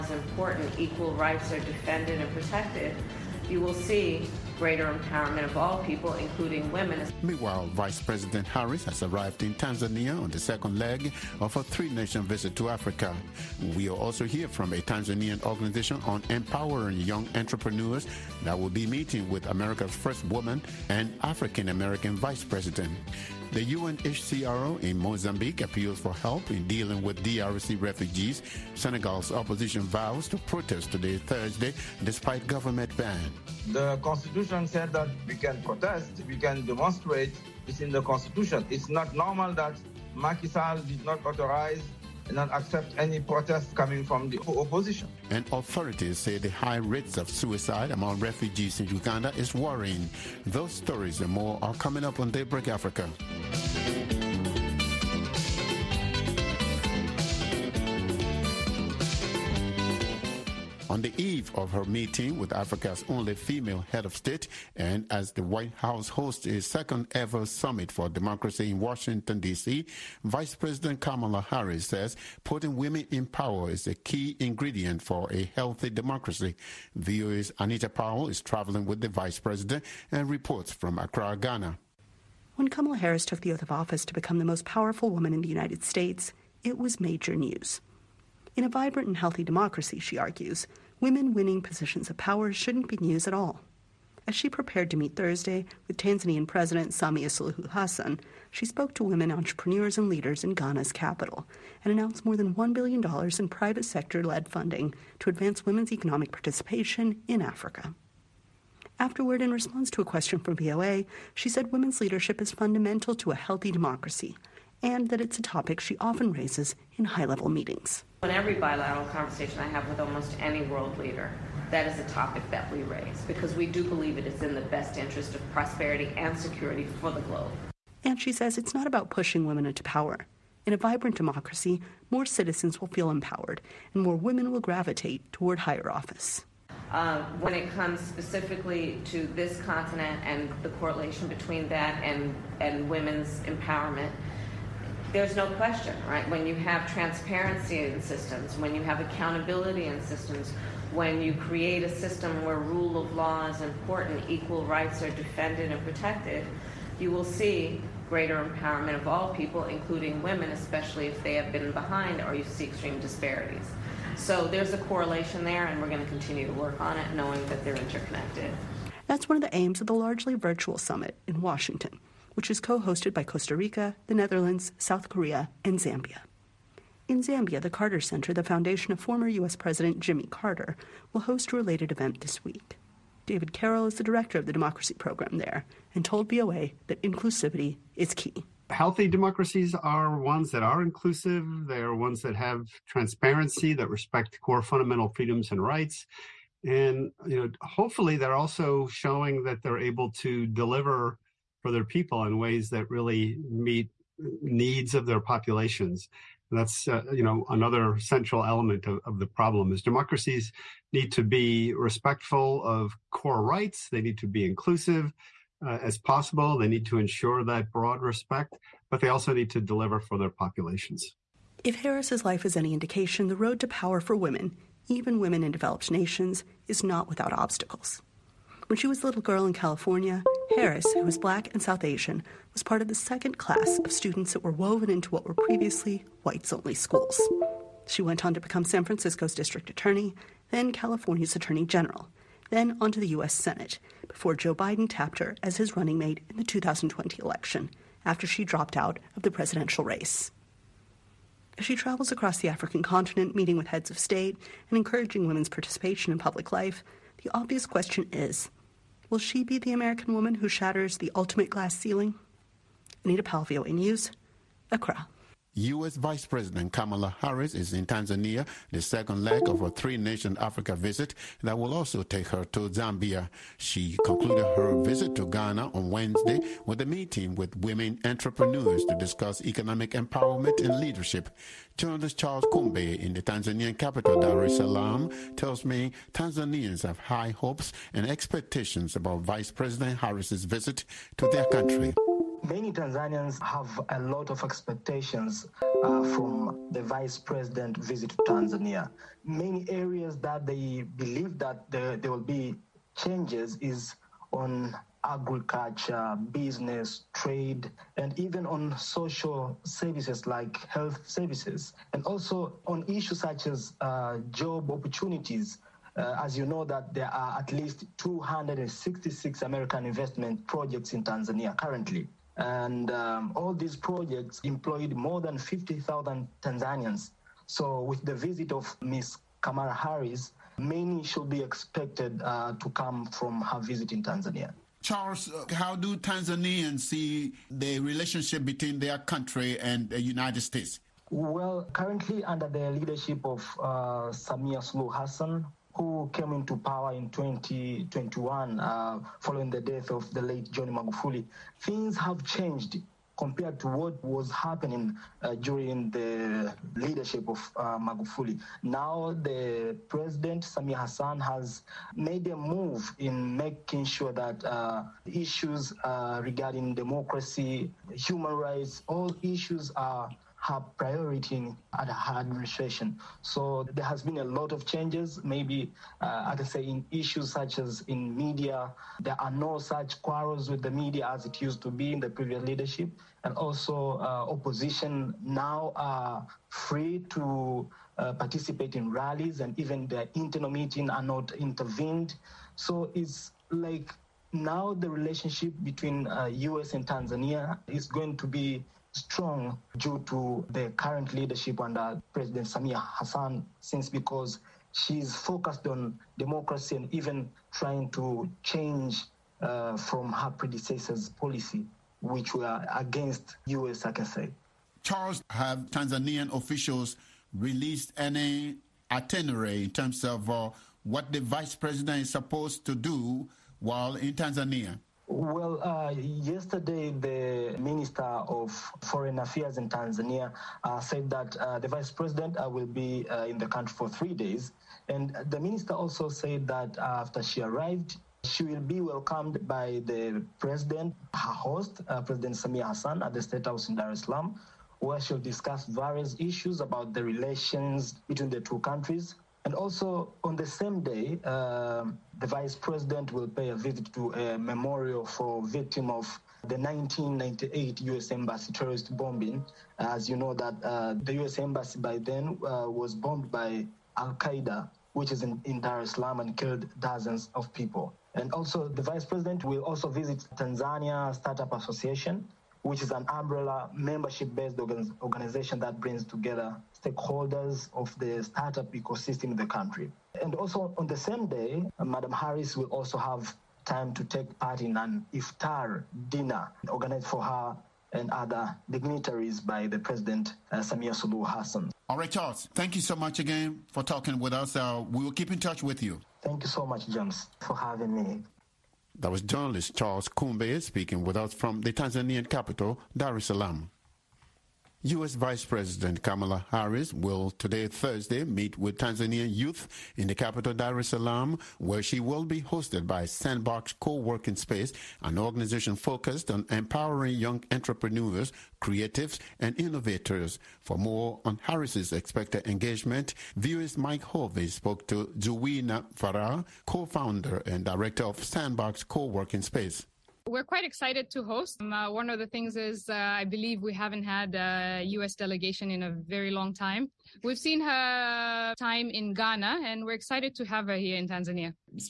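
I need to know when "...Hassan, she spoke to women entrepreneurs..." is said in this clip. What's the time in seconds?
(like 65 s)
97 s.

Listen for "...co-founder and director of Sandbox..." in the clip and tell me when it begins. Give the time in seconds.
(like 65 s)
526 s.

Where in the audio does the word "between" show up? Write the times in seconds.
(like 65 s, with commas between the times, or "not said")
141 s, 338 s, 395 s, 448 s.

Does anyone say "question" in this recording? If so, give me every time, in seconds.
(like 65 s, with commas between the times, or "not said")
110 s, 145 s, 257 s.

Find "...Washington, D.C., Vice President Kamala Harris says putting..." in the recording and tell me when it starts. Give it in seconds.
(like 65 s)
68 s.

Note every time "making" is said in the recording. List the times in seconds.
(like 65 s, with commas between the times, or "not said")
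363 s.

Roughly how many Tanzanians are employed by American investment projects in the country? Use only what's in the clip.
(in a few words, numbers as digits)
More than 50,000.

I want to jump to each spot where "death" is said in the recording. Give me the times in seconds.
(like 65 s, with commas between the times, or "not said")
349 s.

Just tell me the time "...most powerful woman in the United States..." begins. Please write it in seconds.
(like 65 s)
84 s.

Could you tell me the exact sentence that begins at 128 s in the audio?
And she says it's not about pushing women into power.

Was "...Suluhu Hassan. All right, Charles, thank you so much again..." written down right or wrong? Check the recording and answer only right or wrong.
right.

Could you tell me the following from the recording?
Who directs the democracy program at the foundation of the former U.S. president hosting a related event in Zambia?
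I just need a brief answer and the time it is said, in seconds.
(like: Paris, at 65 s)
David Carroll, at 183 s.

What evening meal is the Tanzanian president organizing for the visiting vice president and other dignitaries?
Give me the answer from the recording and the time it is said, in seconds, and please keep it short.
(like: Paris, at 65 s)
Iftar dinner, at 485 s.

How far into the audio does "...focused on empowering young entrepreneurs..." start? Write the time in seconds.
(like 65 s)
515 s.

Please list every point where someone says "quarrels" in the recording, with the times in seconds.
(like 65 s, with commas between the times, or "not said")
380 s.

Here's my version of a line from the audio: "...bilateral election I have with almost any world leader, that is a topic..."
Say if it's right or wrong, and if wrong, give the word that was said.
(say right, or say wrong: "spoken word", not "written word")
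wrong: "conversation", not "election".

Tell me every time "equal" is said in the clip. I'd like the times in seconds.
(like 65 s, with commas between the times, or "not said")
0 s, 154 s.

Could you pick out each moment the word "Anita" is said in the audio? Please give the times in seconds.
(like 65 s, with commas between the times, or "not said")
77 s, 263 s.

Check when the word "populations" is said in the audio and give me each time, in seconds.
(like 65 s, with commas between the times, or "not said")
205 s, 220 s.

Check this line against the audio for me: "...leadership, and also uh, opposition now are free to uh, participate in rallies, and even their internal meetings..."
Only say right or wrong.
right.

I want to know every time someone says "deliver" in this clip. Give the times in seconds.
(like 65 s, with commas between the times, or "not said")
200 s, 219 s.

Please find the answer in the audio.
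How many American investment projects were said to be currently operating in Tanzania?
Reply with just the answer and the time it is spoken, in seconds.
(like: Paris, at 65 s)
266, at 317 s.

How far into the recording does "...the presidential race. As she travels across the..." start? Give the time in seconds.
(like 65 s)
249 s.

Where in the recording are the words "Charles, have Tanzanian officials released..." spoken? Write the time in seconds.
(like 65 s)
414 s.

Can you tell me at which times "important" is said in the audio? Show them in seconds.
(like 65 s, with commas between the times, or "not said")
0 s, 153 s.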